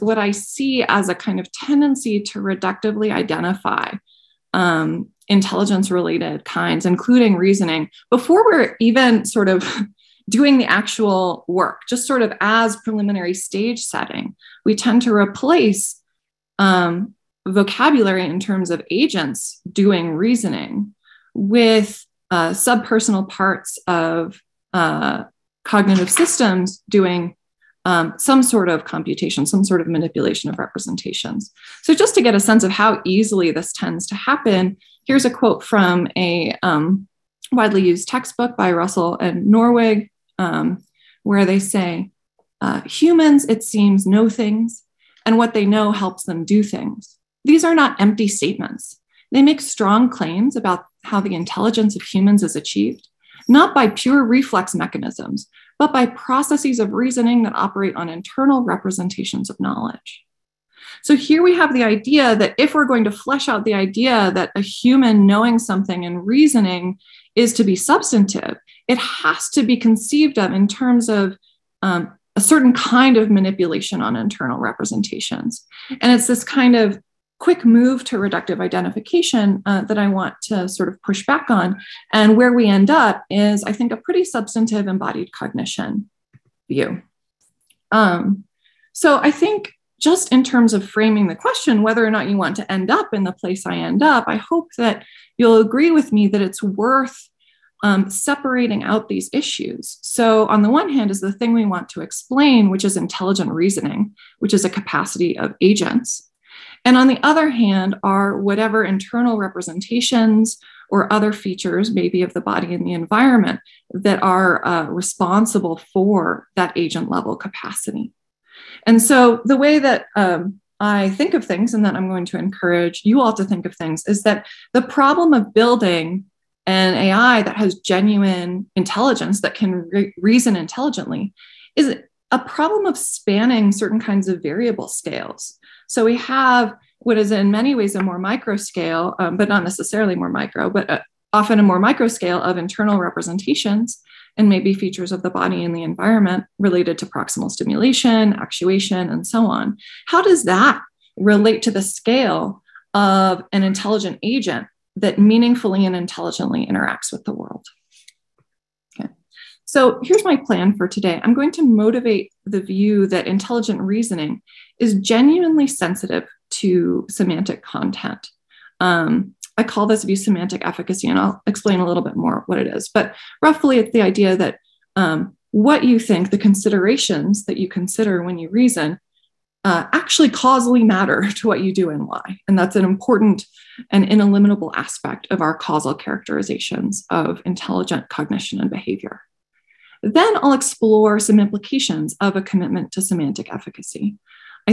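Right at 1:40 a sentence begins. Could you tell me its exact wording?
So, on the one hand, is the thing we want to explain, which is intelligent reasoning, which is a capacity of agents.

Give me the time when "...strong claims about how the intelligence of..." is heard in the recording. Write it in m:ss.
0:49.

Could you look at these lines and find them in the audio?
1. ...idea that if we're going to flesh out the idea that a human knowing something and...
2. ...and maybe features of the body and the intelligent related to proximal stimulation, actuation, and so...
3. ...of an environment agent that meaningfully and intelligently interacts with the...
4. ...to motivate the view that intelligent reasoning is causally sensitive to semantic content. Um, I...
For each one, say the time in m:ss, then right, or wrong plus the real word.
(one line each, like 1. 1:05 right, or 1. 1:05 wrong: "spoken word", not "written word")
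1. 1:01 right
2. 2:24 wrong: "environment", not "intelligent"
3. 2:32 wrong: "intelligent", not "environment"
4. 2:41 wrong: "genuinely", not "causally".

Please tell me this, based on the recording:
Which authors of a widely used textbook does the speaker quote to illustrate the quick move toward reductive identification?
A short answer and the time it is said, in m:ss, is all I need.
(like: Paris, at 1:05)
Russell and Norvig, at 0:38.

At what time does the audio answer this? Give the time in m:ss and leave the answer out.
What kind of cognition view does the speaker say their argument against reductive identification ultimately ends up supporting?
1:24.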